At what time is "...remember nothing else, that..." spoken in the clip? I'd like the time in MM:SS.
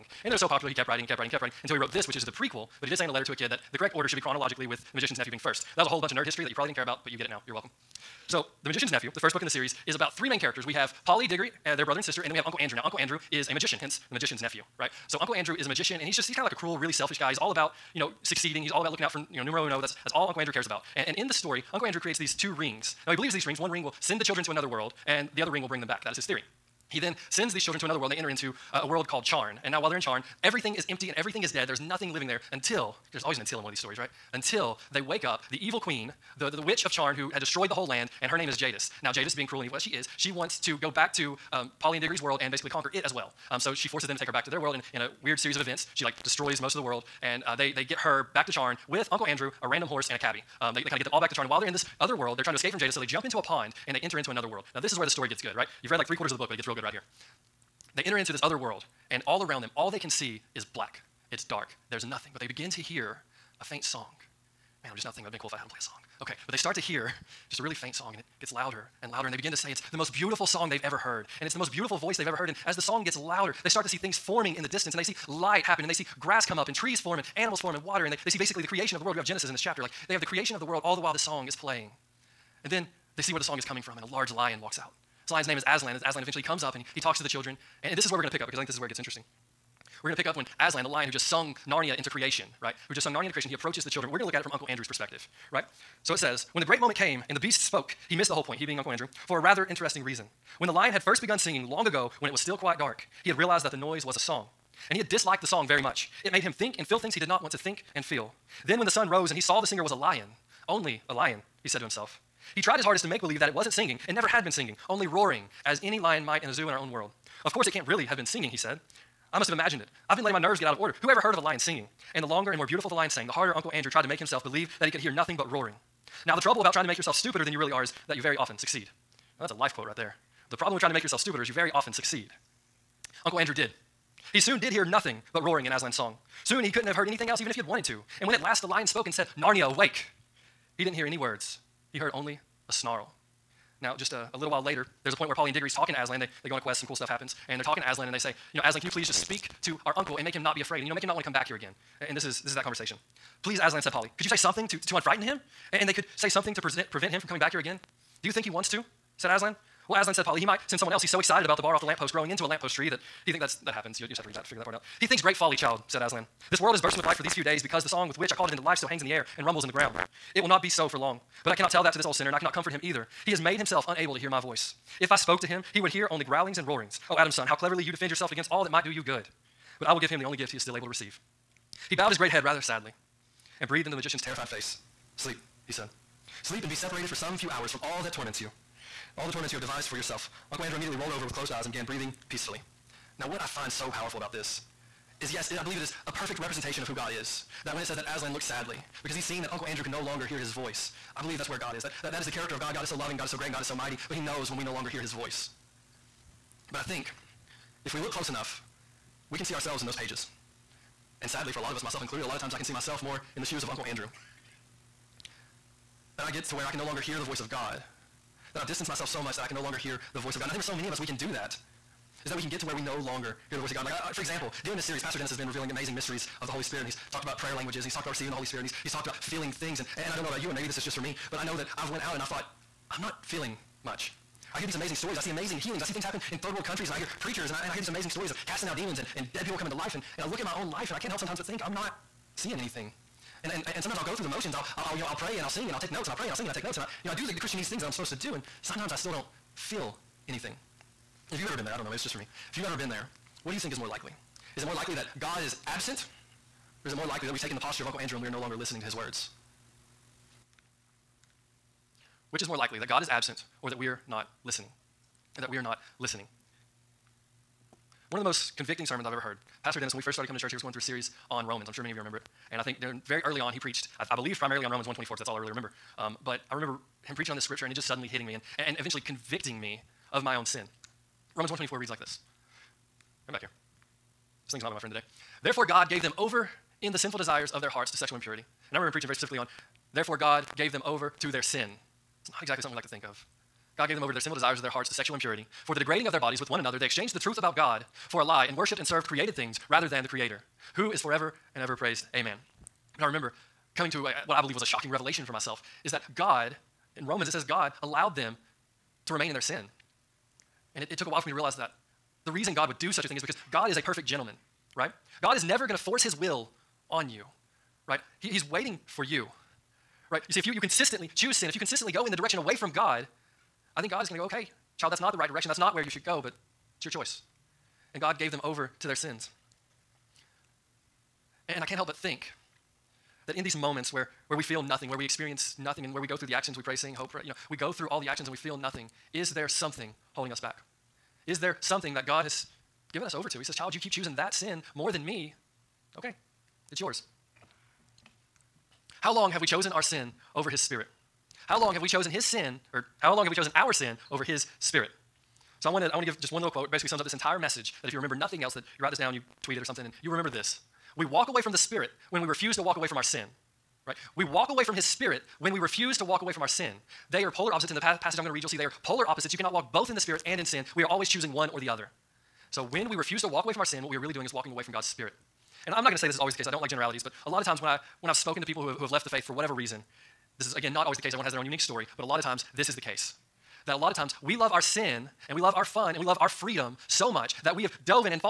05:57.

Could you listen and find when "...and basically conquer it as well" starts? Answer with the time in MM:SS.
00:42.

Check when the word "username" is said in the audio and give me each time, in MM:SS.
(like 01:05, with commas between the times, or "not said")
not said.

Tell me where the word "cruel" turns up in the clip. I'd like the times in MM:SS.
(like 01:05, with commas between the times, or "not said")
00:16, 00:39.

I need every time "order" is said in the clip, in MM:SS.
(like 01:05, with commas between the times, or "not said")
00:03, 02:00.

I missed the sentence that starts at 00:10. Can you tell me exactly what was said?
We have Polly, Diggory, uh, their brother and sister, and then we have Uncle Andrew.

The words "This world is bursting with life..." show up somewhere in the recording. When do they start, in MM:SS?
02:46.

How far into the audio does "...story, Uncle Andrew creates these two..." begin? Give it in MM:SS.
00:21.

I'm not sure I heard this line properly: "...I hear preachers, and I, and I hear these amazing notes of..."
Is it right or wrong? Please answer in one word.
wrong.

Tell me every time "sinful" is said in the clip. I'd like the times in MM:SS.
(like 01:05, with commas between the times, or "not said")
04:46, 04:54.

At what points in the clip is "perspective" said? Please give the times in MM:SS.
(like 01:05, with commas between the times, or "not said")
01:34.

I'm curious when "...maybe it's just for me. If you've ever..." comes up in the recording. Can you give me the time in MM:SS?
04:11.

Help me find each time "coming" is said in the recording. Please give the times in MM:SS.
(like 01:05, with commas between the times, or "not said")
01:23, 02:37, 03:59, 04:30, 05:03.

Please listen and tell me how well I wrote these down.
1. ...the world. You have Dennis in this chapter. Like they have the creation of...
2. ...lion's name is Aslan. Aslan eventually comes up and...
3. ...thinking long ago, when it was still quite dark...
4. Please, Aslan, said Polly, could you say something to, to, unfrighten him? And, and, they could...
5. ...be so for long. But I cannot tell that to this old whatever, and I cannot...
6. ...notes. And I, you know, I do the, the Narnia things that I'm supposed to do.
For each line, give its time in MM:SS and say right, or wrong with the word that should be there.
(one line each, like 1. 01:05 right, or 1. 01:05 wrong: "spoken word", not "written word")
1. 01:19 wrong: "Genesis", not "Dennis"
2. 01:25 right
3. 01:41 wrong: "singing", not "thinking"
4. 02:33 right
5. 02:50 wrong: "sinner", not "whatever"
6. 04:06 wrong: "Christianese", not "Narnia".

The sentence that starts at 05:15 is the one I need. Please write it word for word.
God is never going to force his will on you, right?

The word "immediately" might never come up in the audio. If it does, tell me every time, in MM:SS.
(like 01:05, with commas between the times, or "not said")
03:10.